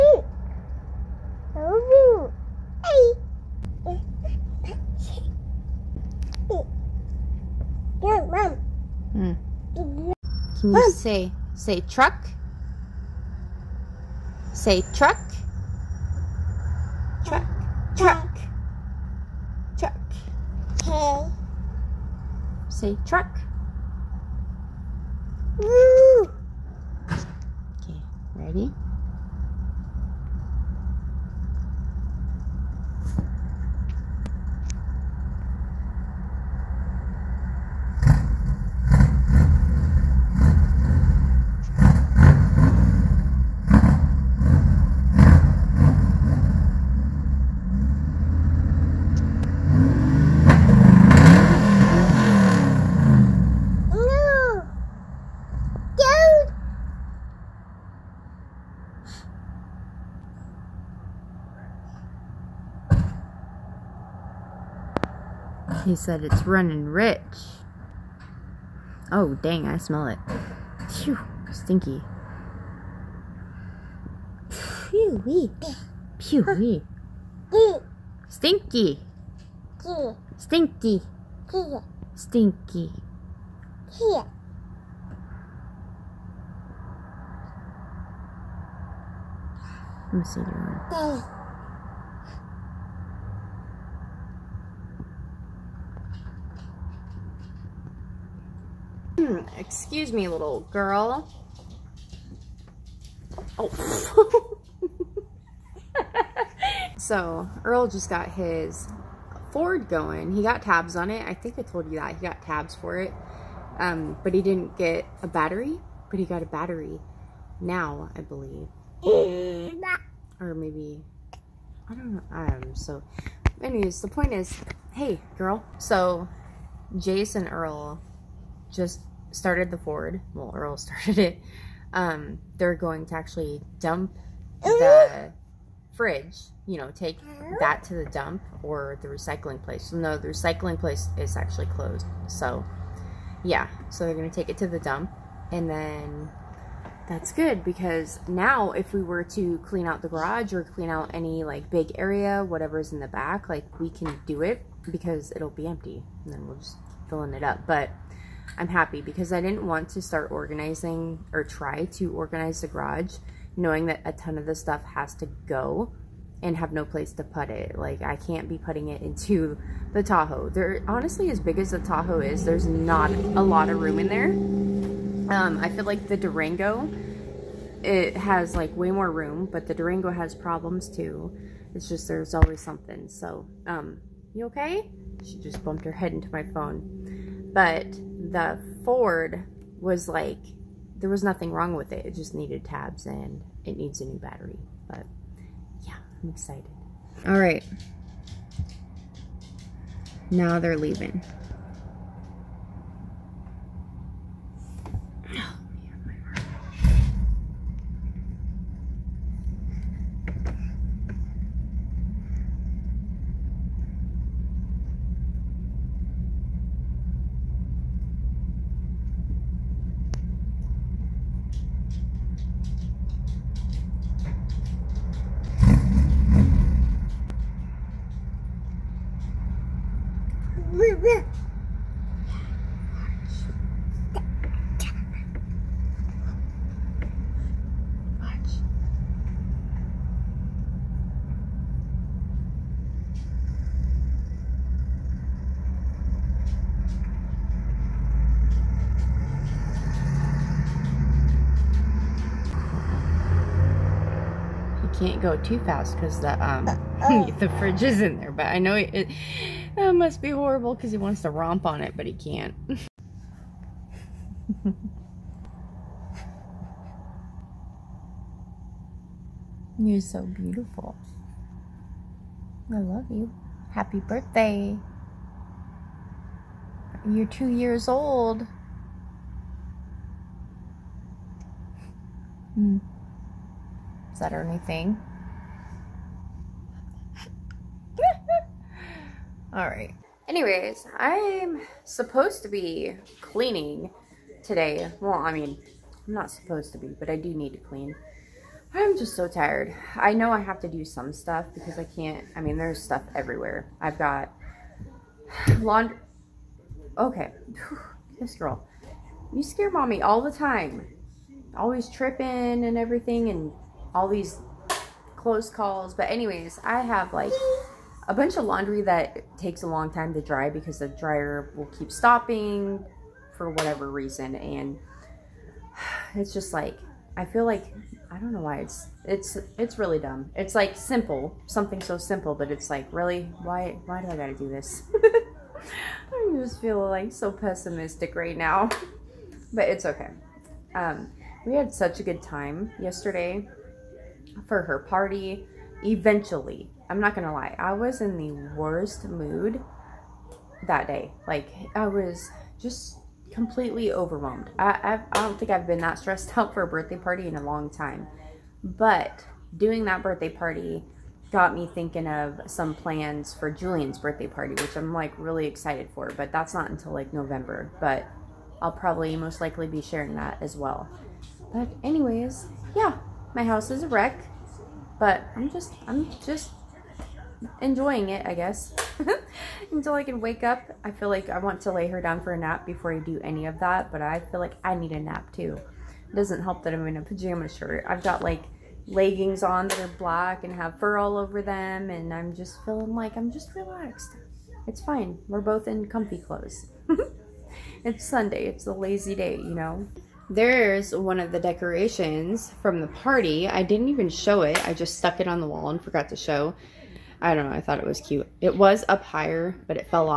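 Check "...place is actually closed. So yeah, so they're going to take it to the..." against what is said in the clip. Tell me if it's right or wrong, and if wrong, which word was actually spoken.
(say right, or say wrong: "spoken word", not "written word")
right.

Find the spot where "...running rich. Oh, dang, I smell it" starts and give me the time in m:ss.
1:06.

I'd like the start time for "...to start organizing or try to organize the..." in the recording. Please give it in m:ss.
2:39.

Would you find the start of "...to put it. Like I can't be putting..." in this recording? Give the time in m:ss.
2:47.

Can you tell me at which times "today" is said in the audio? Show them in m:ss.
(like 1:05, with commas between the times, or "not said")
4:54.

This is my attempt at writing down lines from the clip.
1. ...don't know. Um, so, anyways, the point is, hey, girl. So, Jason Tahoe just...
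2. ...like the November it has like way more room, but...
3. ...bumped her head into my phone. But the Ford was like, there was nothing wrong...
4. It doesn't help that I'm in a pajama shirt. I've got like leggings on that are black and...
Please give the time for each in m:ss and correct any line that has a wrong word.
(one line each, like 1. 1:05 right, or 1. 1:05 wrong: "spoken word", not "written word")
1. 2:01 wrong: "Earl", not "Tahoe"
2. 2:55 wrong: "Durango", not "November"
3. 3:05 right
4. 6:26 right.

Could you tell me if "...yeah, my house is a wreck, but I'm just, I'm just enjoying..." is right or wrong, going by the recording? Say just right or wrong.
right.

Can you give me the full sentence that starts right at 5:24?
And it's just like, I feel like, I don't know why it's, it's, it's really dumb.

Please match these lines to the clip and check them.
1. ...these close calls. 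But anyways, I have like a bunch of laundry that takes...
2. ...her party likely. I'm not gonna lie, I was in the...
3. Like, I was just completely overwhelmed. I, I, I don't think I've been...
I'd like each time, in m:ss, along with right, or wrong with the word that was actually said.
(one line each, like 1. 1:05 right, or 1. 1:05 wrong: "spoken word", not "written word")
1. 5:14 right
2. 5:44 wrong: "eventually", not "likely"
3. 5:51 right.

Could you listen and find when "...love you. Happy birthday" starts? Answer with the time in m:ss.
4:32.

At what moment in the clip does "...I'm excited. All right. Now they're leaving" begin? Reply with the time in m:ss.
3:16.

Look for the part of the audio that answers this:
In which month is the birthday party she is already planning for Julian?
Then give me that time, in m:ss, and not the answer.
6:07.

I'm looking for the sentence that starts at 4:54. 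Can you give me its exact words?
Well, I mean, I'm not supposed to be, but I do need to clean.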